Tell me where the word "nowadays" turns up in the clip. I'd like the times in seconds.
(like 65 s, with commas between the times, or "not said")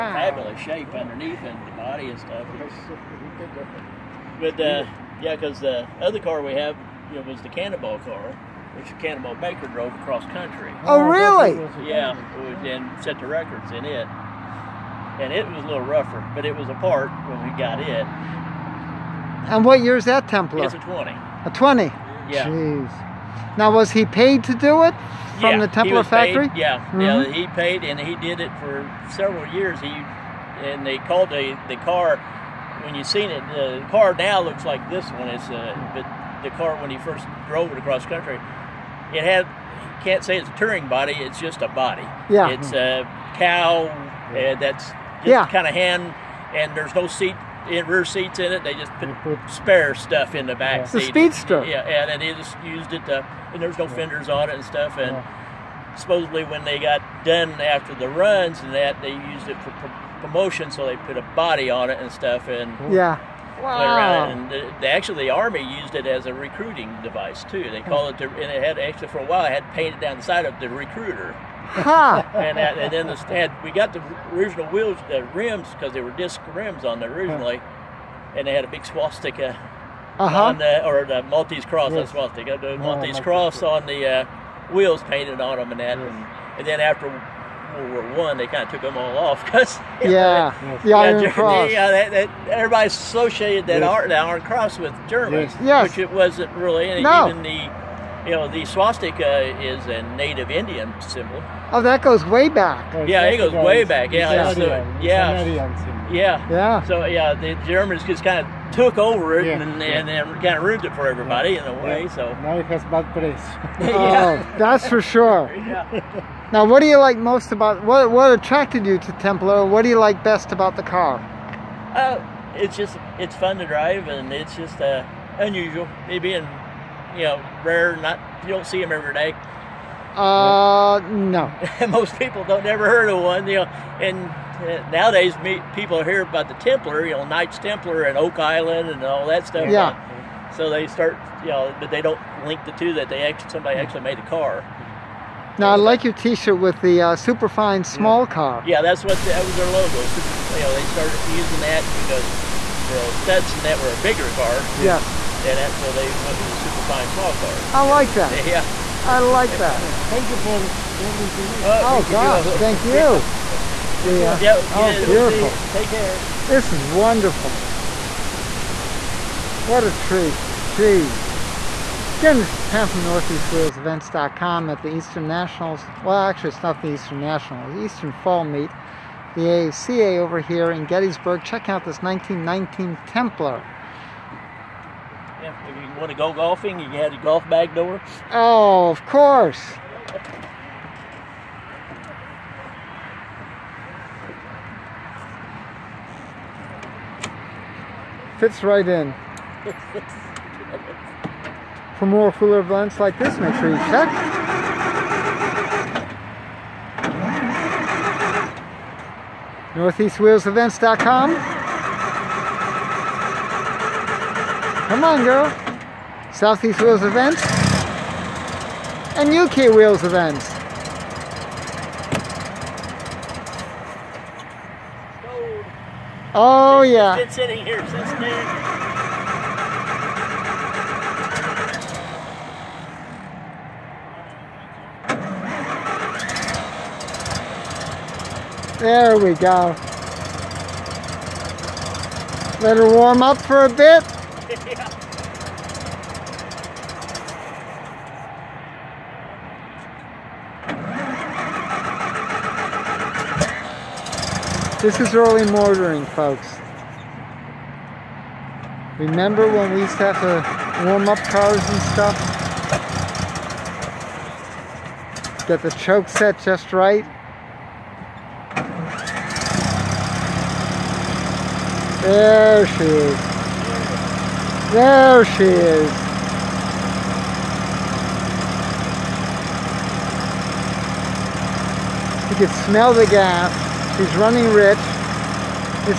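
134 s.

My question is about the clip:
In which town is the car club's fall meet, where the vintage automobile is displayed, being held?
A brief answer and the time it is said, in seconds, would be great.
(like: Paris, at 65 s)
Gettysburg, at 180 s.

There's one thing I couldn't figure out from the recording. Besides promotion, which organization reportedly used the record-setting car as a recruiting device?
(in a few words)
the army.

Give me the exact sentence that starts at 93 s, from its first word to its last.
art, that Iron Cross, with Germans, yes.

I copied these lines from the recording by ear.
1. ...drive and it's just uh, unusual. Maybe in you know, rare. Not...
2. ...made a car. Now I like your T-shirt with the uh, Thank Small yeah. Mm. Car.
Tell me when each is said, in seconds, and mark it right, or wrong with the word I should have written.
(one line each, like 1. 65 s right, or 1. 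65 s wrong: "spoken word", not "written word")
1. 123 s right
2. 144 s wrong: "Superfine", not "Thank".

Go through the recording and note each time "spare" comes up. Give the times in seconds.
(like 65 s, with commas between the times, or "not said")
49 s.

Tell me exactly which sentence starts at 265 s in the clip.
Get the choke set just right.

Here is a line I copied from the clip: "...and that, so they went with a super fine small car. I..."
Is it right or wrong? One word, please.
right.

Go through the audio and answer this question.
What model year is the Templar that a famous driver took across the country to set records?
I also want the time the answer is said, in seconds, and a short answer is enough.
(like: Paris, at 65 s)
1920, at 20 s.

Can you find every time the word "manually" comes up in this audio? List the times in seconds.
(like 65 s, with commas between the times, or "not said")
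not said.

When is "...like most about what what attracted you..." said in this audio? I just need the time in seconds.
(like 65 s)
116 s.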